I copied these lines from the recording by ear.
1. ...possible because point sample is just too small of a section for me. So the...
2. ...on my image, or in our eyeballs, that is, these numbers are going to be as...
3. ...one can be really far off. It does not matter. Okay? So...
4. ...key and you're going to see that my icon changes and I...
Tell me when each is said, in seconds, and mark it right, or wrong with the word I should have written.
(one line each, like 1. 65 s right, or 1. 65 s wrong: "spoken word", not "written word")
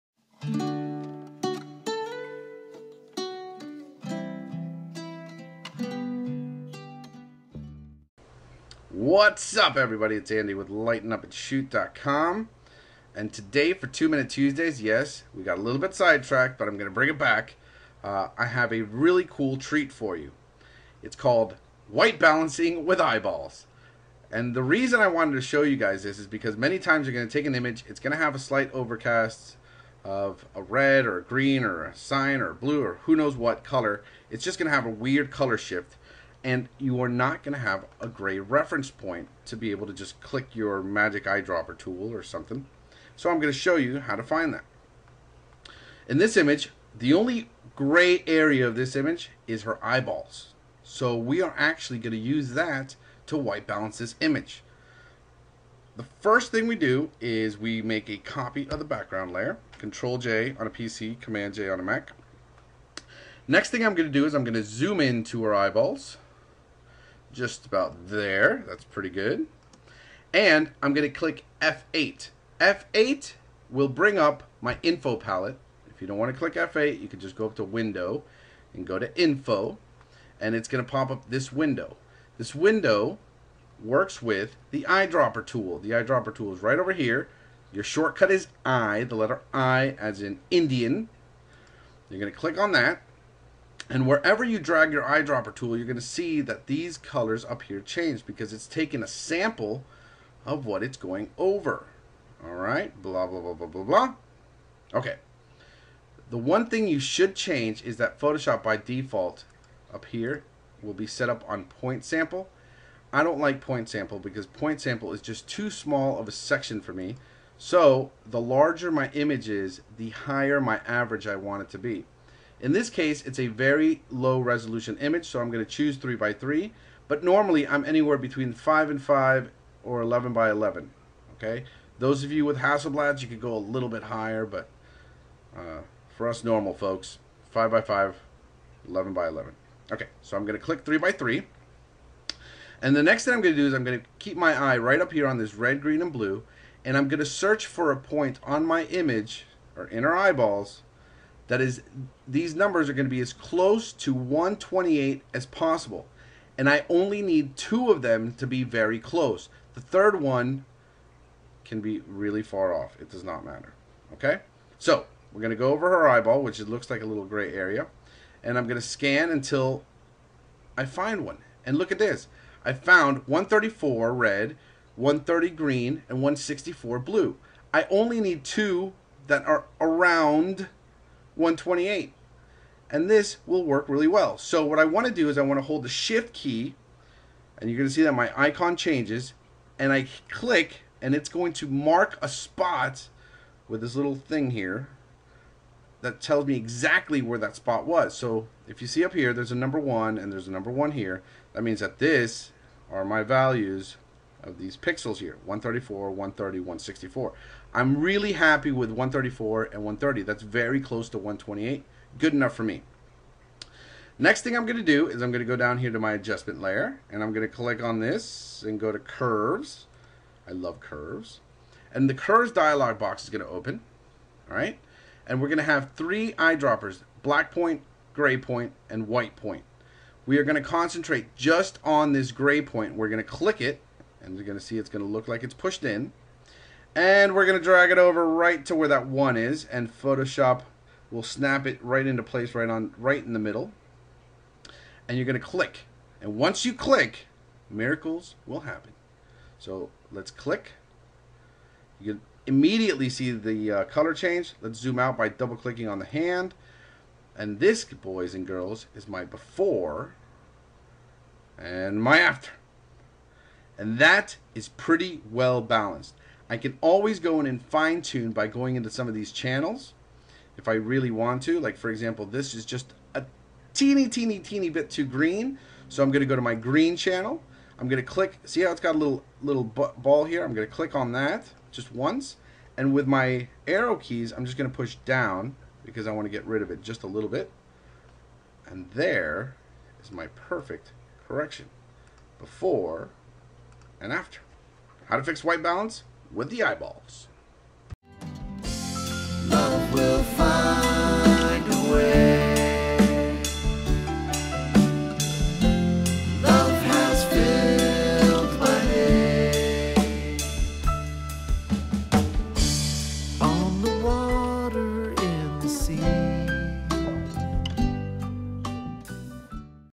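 1. 113 s wrong: "sample", not "possible"
2. 148 s right
3. 160 s right
4. 186 s right.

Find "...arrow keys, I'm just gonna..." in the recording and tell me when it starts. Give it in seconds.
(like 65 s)
283 s.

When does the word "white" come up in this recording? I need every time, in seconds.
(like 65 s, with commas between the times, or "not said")
21 s, 53 s, 229 s, 295 s.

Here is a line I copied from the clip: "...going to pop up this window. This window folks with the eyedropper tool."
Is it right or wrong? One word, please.
wrong.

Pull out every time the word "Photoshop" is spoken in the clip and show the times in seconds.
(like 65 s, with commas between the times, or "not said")
108 s, 239 s.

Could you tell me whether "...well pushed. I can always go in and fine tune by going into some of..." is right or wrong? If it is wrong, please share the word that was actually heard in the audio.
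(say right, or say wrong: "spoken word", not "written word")
wrong: "balanced", not "pushed".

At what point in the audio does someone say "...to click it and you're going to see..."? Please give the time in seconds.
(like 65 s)
233 s.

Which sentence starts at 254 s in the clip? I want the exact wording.
Let's zoom out by double clicking on the hand.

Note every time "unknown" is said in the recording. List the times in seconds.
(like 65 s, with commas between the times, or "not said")
not said.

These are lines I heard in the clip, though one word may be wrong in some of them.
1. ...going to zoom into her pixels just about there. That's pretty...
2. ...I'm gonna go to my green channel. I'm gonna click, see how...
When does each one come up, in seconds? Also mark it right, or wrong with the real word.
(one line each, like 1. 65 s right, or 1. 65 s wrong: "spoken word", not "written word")
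1. 64 s wrong: "eyeballs", not "pixels"
2. 276 s right.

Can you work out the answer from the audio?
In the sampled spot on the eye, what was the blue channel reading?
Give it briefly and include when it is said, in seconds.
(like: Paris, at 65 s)
164, at 176 s.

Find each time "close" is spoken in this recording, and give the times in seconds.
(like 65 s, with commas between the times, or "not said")
153 s, 158 s, 210 s.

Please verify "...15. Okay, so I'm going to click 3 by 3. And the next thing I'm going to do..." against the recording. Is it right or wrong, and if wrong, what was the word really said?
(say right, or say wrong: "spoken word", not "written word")
wrong: "11", not "15".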